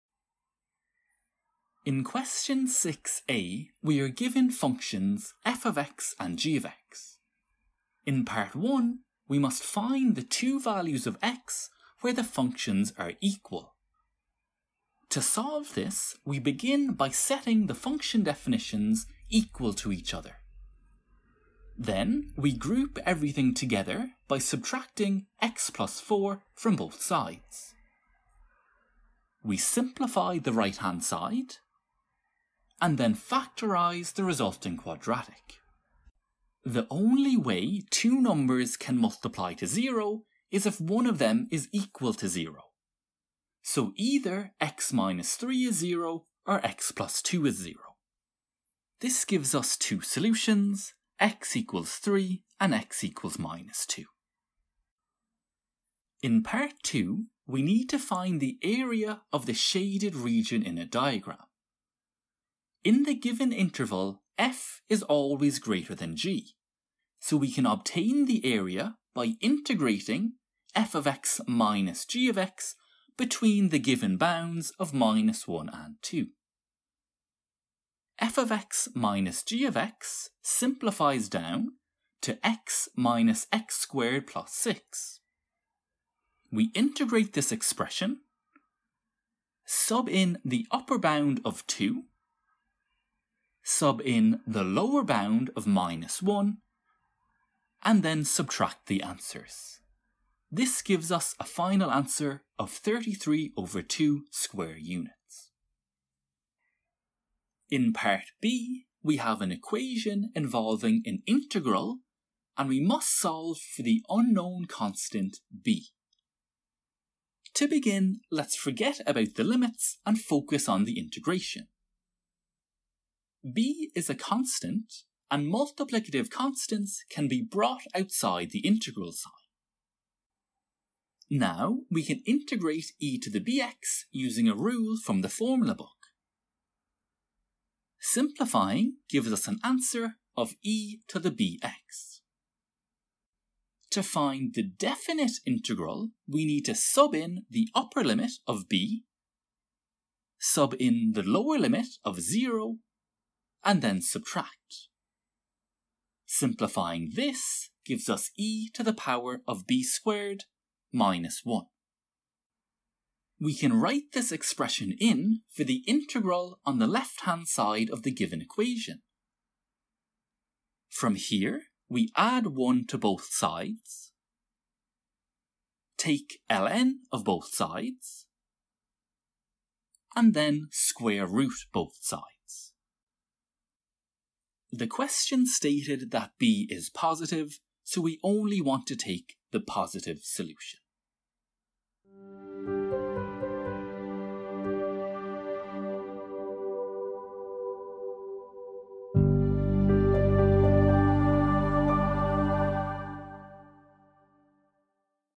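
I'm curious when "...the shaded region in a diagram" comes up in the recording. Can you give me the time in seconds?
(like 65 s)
59 s.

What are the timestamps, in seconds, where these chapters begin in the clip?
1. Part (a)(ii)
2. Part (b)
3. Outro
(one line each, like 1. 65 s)
1. 56 s
2. 107 s
3. 192 s.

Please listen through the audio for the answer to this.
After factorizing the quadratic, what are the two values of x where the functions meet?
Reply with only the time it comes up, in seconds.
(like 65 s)
51 s.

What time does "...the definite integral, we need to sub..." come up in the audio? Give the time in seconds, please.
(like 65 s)
144 s.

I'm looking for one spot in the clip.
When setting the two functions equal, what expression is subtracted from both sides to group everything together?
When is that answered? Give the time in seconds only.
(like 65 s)
25 s.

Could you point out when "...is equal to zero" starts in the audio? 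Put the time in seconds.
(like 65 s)
41 s.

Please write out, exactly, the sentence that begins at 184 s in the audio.
The question stated that B is positive, so we only want to take the positive solution.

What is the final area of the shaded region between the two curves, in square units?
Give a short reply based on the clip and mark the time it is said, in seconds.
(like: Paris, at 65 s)
33/2, at 102 s.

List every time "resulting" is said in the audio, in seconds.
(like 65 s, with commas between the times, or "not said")
34 s.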